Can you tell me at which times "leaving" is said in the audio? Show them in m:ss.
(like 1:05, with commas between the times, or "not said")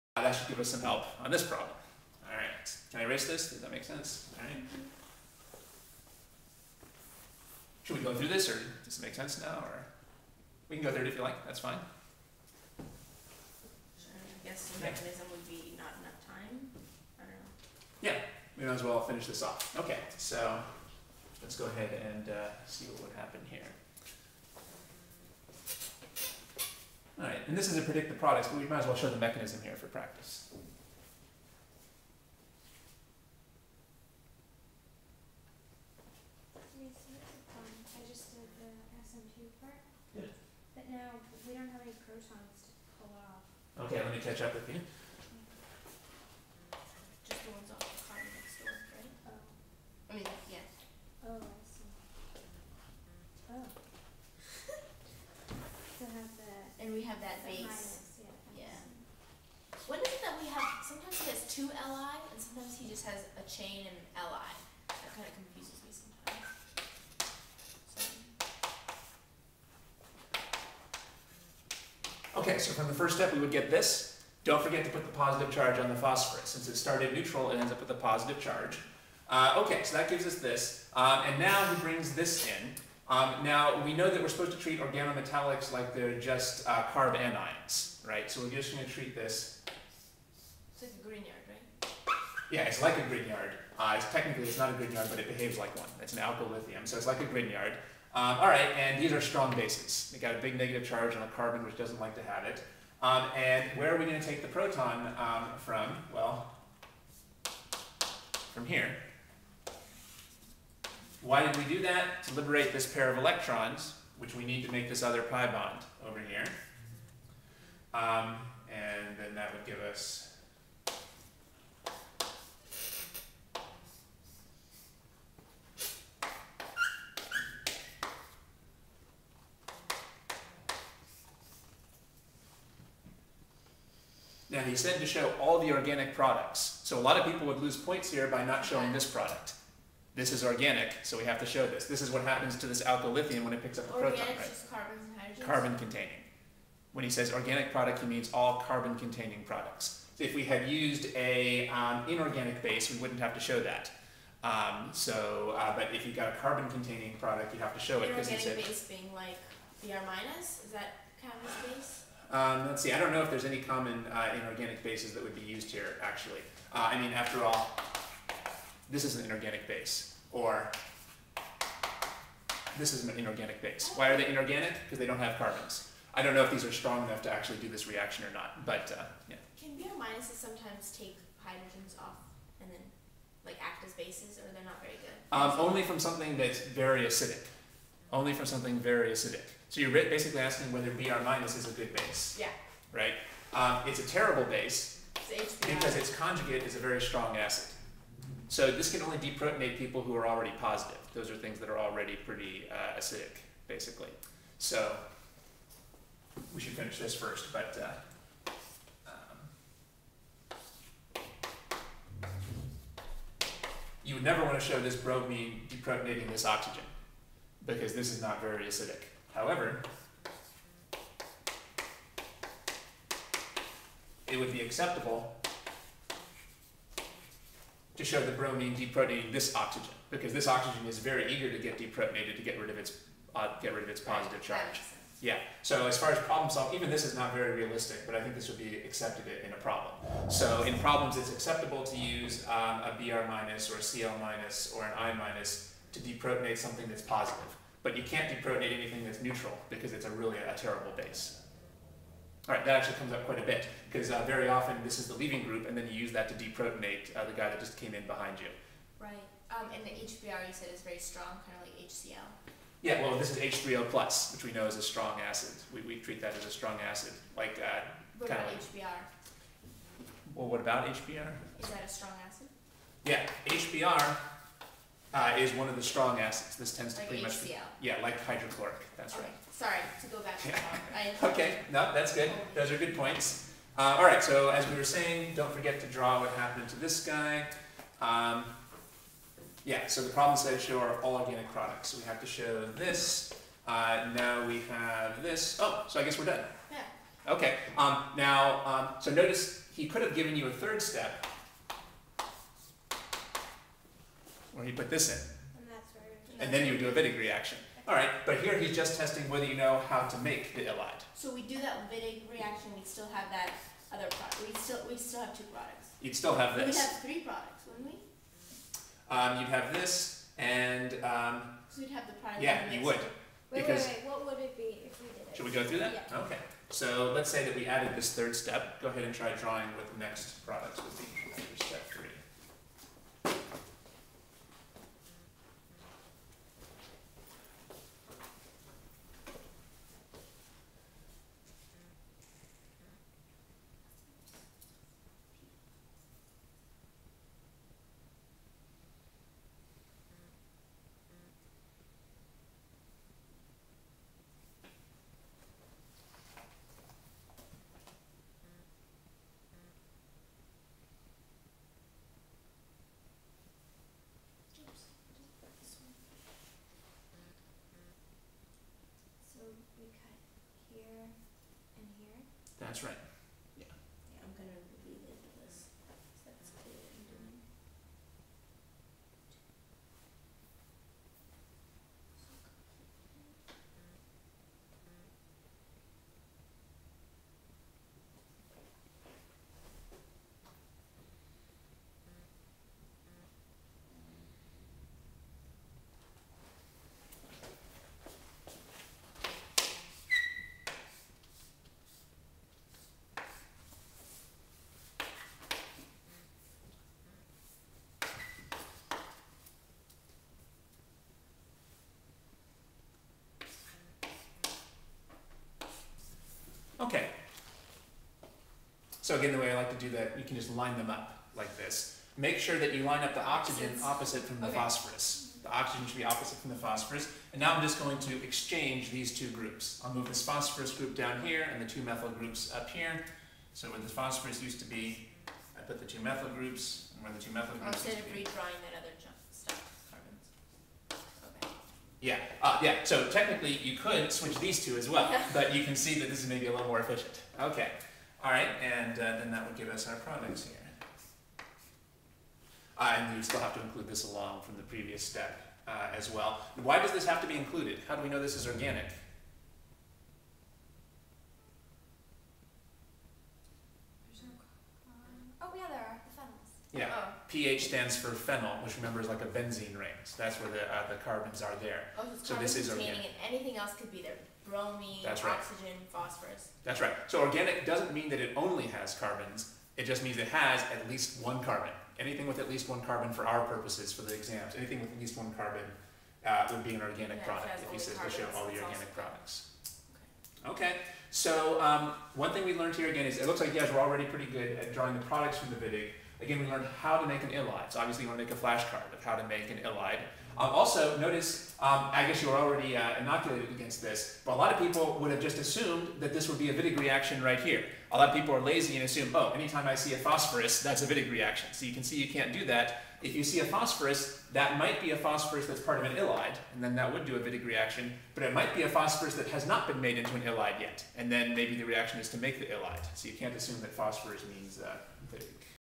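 4:15.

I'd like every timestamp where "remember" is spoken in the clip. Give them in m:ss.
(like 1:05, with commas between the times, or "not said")
7:48.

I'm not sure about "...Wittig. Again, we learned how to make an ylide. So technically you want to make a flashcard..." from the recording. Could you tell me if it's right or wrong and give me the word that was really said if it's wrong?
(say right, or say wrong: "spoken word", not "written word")
wrong: "obviously", not "technically".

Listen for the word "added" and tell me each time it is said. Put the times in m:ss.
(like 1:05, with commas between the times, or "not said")
5:27.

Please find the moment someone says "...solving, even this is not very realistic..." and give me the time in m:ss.
3:56.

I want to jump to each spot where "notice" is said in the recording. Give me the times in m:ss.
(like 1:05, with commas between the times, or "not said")
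4:59, 8:20.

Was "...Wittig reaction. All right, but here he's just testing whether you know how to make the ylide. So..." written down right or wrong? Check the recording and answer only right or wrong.
right.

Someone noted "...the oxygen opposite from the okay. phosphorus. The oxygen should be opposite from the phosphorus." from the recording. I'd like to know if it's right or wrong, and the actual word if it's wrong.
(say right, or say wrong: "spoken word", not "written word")
right.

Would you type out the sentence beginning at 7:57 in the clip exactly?
So organic doesn't mean that it only has carbons.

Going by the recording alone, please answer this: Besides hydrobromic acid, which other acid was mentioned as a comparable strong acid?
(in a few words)
hydrochloric.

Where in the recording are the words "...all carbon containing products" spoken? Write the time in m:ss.
2:28.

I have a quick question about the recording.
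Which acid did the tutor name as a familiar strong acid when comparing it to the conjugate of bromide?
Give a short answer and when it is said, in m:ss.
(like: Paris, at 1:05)
H3O plus, at 4:23.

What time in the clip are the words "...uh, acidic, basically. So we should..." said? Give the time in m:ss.
3:22.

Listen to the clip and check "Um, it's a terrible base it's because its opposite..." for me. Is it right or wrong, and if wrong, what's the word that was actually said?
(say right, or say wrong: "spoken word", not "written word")
wrong: "conjugate", not "opposite".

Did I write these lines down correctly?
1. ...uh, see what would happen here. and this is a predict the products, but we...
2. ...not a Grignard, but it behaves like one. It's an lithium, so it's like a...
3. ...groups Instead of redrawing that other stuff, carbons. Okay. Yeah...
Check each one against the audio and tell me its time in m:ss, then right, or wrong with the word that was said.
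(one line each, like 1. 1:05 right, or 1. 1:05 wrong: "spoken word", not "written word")
1. 0:22 right
2. 1:34 right
3. 7:17 right.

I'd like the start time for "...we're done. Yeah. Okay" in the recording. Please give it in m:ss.
4:56.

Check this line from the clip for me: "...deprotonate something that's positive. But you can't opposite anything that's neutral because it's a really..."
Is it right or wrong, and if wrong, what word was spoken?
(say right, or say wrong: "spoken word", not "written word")
wrong: "deprotonate", not "opposite".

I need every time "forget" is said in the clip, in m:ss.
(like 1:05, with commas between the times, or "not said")
1:14, 4:45.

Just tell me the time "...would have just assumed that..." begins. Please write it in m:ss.
8:25.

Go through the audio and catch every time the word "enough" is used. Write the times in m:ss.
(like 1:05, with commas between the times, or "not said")
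0:16, 2:57.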